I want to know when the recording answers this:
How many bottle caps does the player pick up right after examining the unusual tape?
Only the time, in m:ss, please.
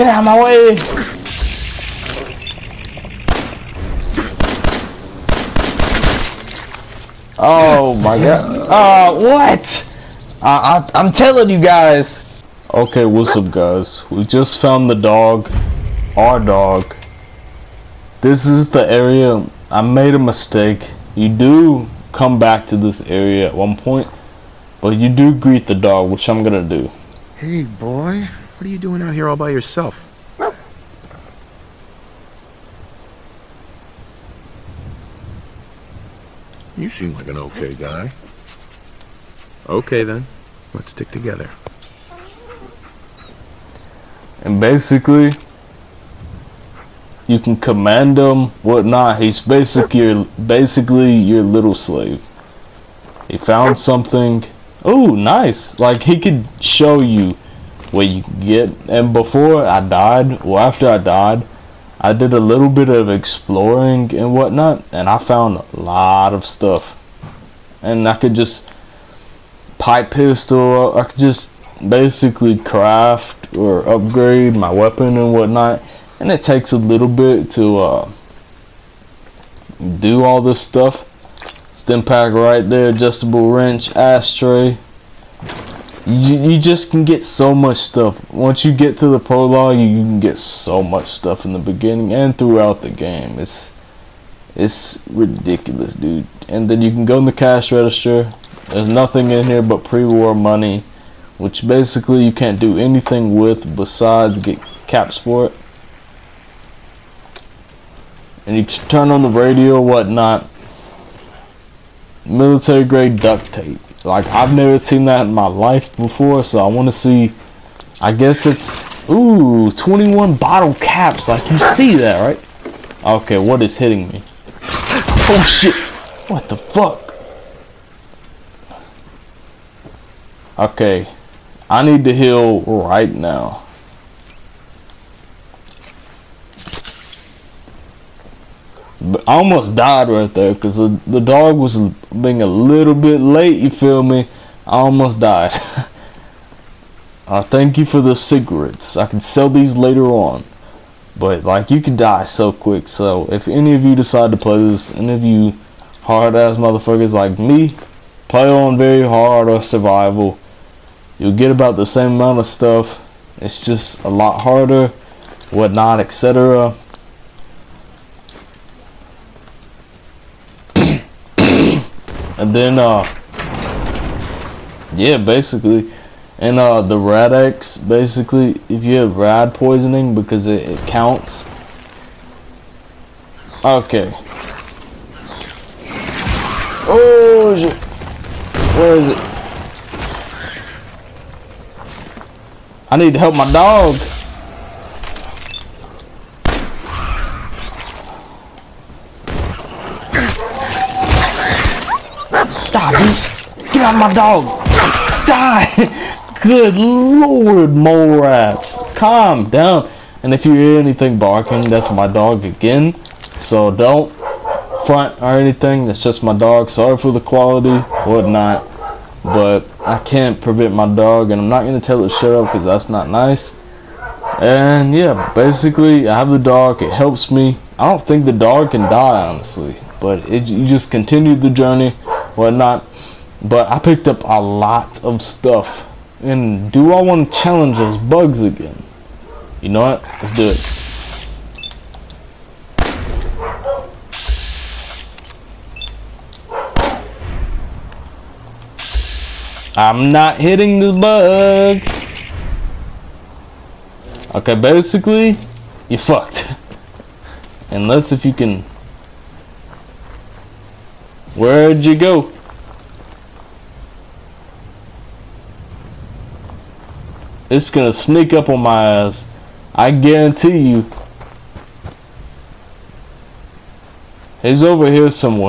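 1:59.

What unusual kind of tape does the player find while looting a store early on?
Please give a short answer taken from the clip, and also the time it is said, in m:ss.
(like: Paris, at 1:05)
Military grade duct tape, at 1:52.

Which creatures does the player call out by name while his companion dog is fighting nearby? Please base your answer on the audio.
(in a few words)
Mole rats.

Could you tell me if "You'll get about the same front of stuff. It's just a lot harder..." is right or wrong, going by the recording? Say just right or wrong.
wrong.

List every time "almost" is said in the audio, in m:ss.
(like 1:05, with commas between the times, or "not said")
2:19, 2:24.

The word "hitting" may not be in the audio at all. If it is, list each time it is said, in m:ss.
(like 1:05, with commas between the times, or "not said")
2:03, 4:10.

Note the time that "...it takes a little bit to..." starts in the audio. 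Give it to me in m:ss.
1:16.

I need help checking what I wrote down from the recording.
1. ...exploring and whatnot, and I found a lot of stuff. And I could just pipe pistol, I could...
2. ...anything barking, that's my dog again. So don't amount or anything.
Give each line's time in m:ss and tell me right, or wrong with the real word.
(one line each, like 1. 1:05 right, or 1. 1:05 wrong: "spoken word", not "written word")
1. 1:03 right
2. 3:30 wrong: "front", not "amount".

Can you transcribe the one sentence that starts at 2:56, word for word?
And uh, the Rad-X, basically, if you have rad poisoning, because it, it counts.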